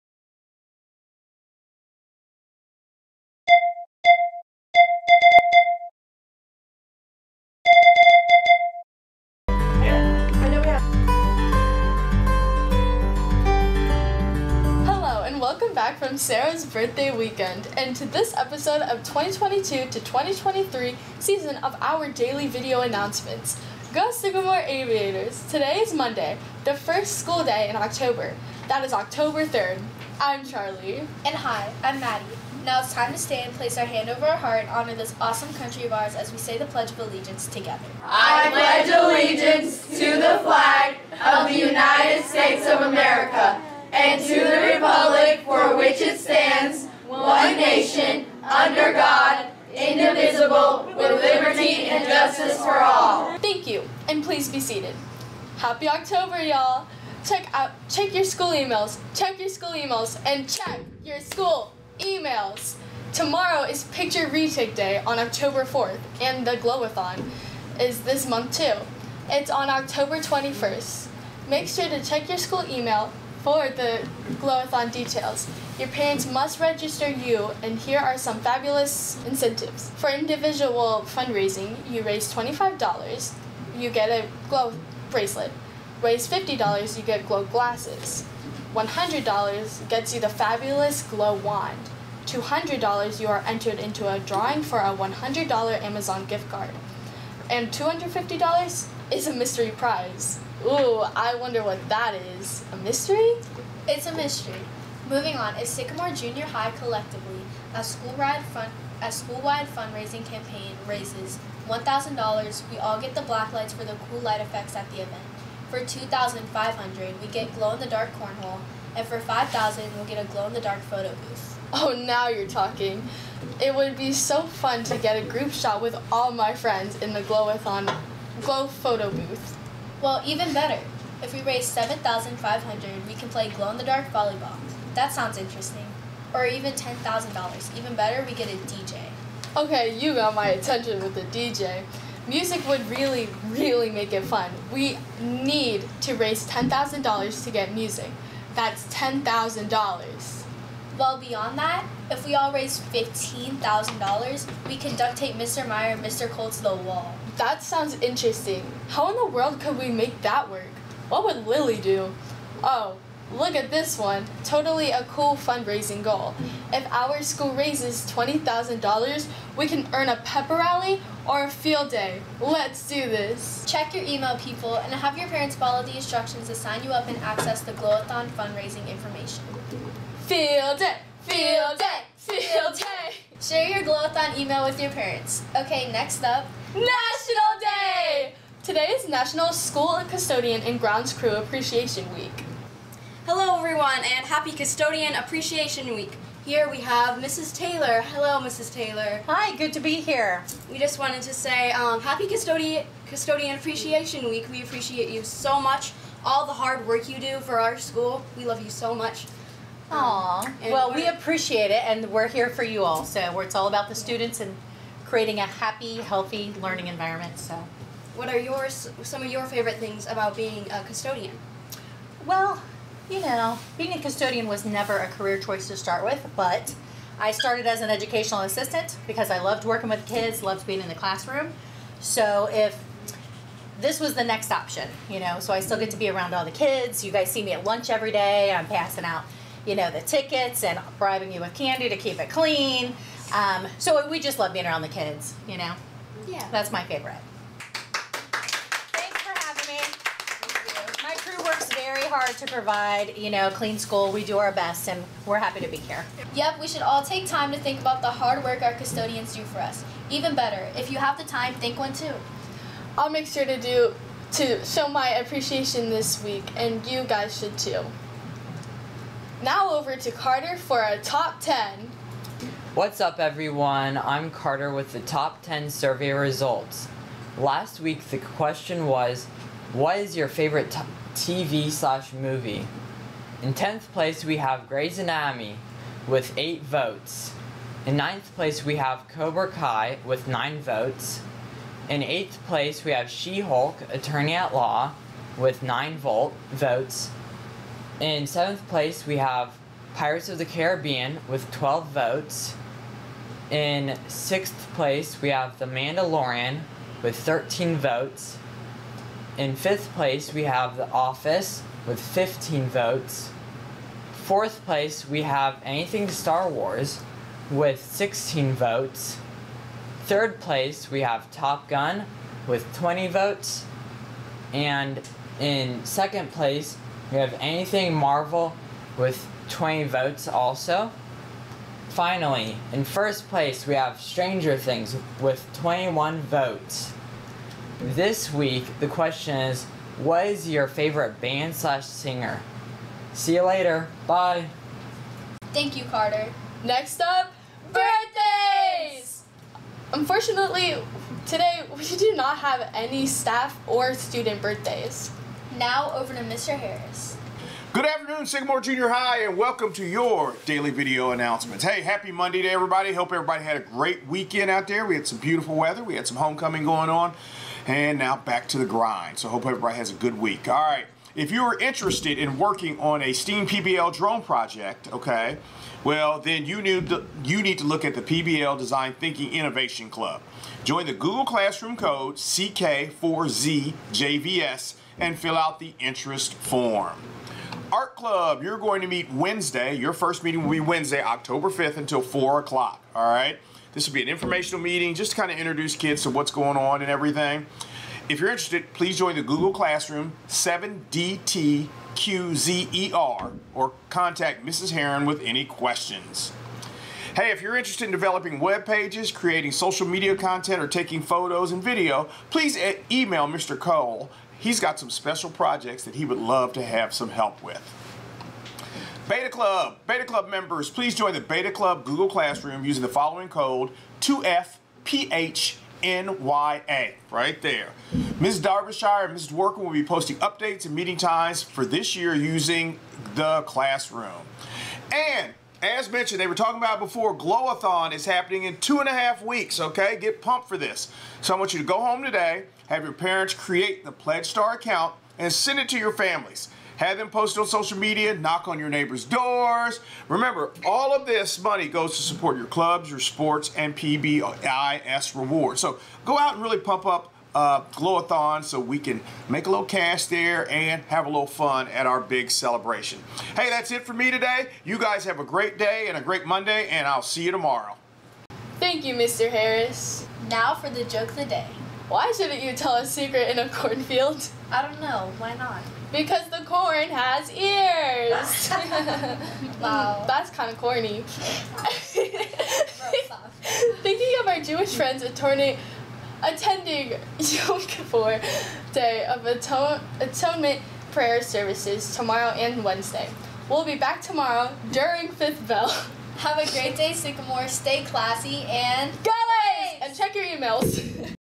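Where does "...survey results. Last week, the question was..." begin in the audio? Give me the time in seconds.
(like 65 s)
275 s.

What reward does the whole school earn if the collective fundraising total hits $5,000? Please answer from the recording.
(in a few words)
Glow-in-the-dark photo booth.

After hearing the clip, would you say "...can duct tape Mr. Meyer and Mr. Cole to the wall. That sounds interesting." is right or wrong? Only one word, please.
right.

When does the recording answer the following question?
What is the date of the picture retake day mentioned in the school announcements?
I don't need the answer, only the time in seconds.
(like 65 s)
65 s.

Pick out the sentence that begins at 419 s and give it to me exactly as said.
Beta Club, Beta Club members, please join the Beta Club Google Classroom using the following code 2FPHNYA, right there.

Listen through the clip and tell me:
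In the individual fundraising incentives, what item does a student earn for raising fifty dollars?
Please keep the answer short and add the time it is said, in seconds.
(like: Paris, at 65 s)
Glow glasses, at 87 s.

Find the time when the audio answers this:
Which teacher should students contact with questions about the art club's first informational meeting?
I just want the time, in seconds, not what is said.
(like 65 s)
404 s.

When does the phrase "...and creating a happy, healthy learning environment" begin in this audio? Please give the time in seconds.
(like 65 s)
214 s.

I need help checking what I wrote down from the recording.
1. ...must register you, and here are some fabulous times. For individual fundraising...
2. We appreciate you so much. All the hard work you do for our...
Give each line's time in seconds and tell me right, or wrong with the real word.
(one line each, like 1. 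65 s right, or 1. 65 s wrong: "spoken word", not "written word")
1. 76 s wrong: "incentives", not "times"
2. 204 s right.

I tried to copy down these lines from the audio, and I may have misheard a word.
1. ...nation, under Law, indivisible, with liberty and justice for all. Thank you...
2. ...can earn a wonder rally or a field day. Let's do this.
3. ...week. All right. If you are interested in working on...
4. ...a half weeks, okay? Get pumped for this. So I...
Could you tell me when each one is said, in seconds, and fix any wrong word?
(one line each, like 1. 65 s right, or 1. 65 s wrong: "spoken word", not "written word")
1. 47 s wrong: "God", not "Law"
2. 169 s wrong: "pepper", not "wonder"
3. 370 s right
4. 438 s right.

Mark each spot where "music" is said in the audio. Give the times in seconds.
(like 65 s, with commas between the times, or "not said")
142 s, 147 s.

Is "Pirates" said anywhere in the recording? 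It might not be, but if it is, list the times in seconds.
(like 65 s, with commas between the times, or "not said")
299 s.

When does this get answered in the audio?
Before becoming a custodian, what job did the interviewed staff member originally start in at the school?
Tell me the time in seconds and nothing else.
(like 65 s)
227 s.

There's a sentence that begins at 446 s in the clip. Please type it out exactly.
Have them post it on social media, knock on your neighbors' doors.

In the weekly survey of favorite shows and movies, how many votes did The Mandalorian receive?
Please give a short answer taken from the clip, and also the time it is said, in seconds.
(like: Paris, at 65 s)
13, at 307 s.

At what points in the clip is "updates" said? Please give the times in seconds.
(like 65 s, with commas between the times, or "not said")
430 s.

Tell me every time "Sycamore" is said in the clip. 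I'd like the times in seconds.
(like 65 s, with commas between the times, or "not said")
24 s, 105 s, 358 s, 496 s.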